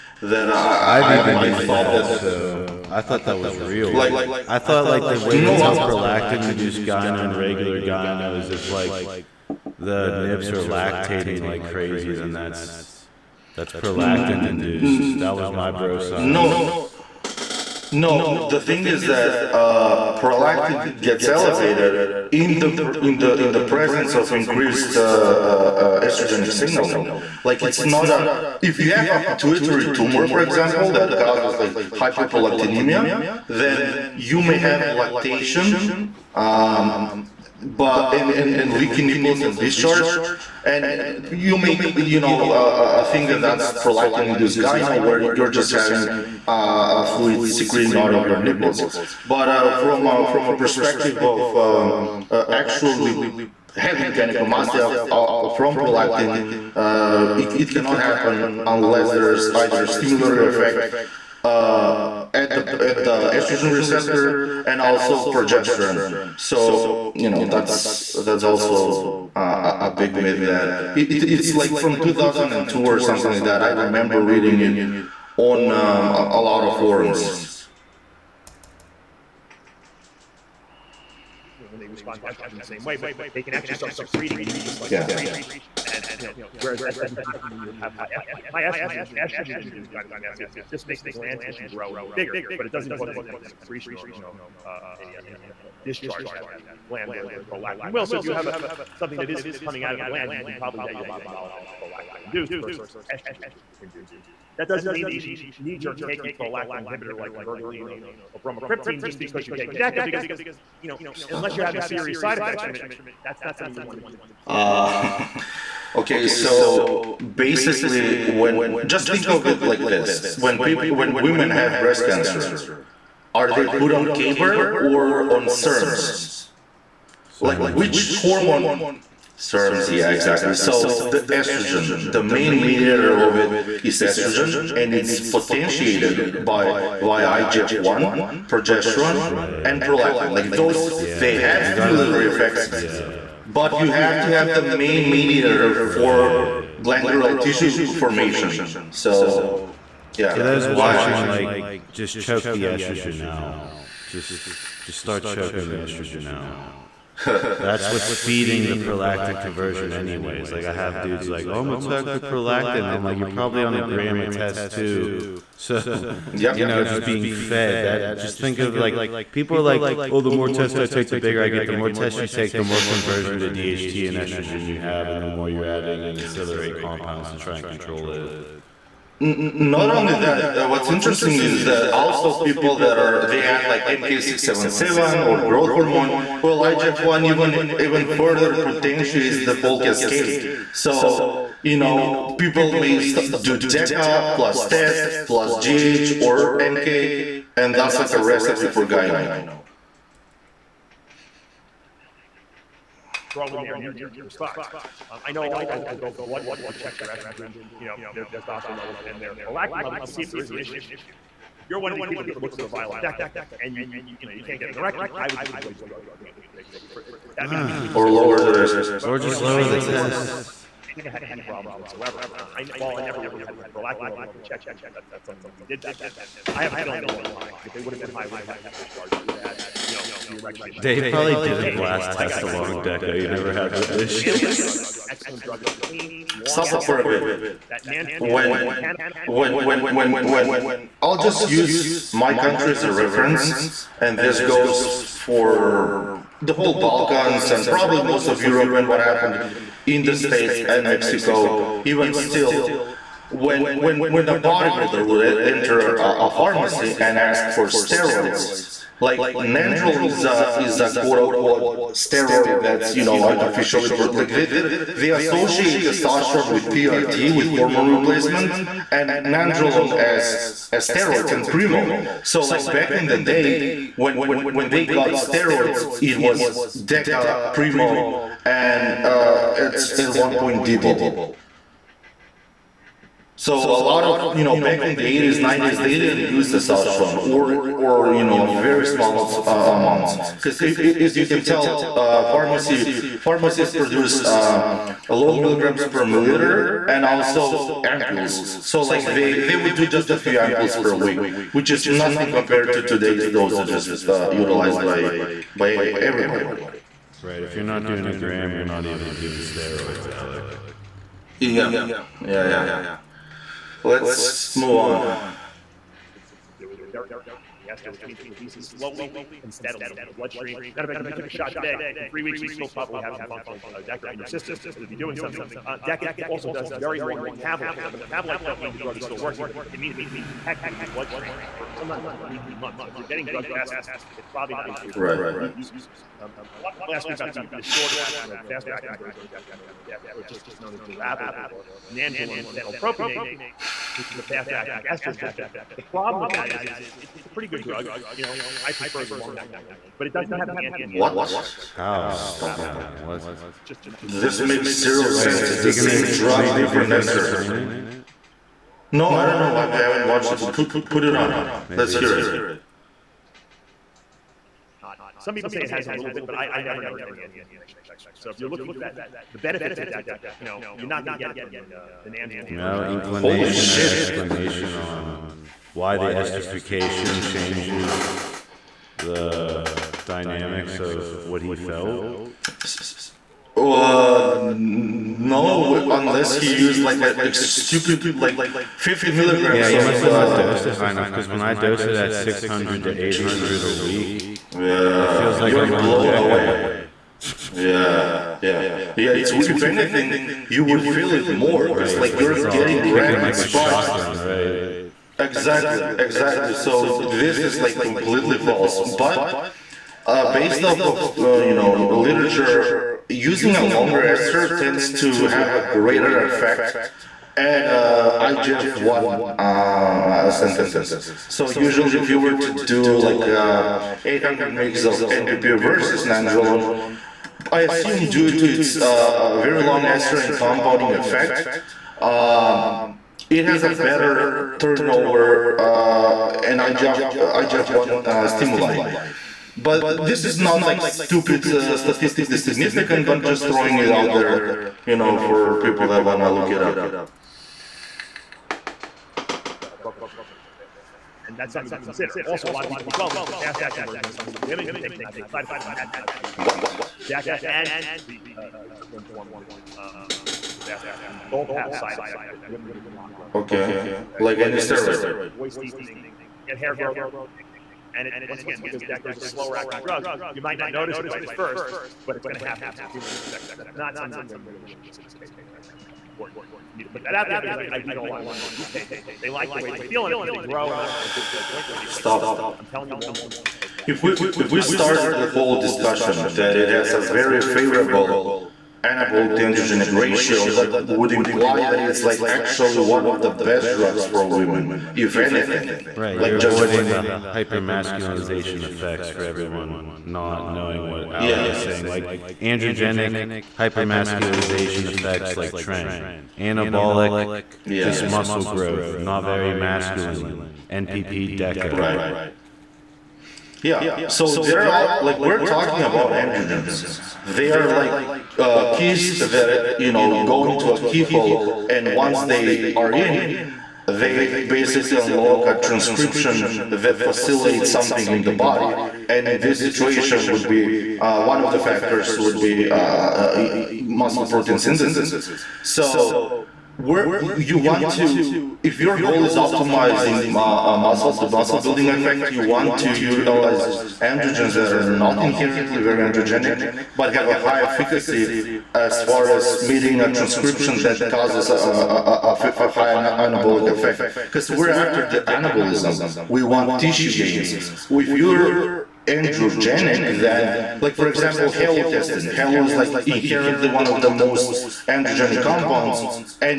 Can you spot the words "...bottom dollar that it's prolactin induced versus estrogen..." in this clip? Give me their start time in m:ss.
1:41.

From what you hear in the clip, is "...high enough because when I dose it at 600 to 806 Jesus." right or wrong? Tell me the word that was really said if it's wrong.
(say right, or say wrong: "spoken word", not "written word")
wrong: "800", not "806".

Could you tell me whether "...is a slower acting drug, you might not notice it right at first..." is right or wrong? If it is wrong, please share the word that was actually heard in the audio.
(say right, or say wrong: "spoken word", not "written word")
right.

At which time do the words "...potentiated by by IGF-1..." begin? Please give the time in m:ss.
2:15.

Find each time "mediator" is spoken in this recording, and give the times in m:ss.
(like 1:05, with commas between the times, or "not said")
2:12, 2:25.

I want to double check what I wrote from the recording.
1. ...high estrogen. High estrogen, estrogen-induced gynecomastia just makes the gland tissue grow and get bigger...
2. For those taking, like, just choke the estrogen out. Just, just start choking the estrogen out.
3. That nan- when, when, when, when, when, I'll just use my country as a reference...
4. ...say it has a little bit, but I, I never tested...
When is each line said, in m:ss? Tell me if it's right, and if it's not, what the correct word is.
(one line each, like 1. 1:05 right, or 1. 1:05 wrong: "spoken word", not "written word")
1. 1:27 right
2. 2:30 wrong: "watching", not "taking"
3. 3:57 right
4. 6:05 wrong: "noticed", not "tested".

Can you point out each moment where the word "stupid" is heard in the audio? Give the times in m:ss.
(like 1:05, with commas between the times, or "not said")
6:27, 7:20.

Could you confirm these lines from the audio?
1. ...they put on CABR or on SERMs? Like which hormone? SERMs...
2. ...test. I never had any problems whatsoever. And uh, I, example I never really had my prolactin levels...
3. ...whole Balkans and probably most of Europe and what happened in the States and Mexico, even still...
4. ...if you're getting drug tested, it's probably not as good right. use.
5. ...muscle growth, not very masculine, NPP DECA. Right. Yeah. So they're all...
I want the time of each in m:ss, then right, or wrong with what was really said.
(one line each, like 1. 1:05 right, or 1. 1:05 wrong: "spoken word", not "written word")
1. 2:03 right
2. 3:39 wrong: "while", not "example"
3. 4:06 right
4. 5:32 right
5. 8:28 right.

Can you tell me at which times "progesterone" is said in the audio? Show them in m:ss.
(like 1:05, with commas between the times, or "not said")
1:05, 2:18.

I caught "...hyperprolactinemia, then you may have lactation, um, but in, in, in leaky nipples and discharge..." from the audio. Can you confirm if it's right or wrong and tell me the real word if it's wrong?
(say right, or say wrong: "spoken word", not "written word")
right.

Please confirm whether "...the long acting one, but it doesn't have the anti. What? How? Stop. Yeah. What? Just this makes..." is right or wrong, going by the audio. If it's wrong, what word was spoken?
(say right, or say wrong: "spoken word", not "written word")
right.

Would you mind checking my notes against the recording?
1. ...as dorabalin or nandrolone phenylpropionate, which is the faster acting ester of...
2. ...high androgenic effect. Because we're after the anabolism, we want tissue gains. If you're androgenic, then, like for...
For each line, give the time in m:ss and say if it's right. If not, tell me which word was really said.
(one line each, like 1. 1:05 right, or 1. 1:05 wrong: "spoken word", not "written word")
1. 5:40 right
2. 9:12 wrong: "anabolic", not "androgenic".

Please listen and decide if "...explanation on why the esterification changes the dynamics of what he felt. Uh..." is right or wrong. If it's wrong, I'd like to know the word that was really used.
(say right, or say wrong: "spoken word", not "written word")
right.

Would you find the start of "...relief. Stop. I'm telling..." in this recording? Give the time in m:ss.
8:01.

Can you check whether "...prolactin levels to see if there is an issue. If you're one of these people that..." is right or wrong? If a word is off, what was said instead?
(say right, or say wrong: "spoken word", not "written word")
right.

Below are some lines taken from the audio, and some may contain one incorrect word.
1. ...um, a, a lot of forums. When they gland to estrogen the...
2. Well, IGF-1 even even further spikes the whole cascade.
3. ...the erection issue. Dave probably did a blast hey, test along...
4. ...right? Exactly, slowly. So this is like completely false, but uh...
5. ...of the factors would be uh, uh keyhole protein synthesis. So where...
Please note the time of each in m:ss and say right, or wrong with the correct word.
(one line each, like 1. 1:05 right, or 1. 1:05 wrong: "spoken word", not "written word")
1. 1:15 wrong: "respond", not "gland"
2. 3:06 wrong: "potentiates", not "spikes"
3. 3:50 right
4. 6:44 wrong: "exactly", not "slowly"
5. 8:51 wrong: "muscle", not "keyhole".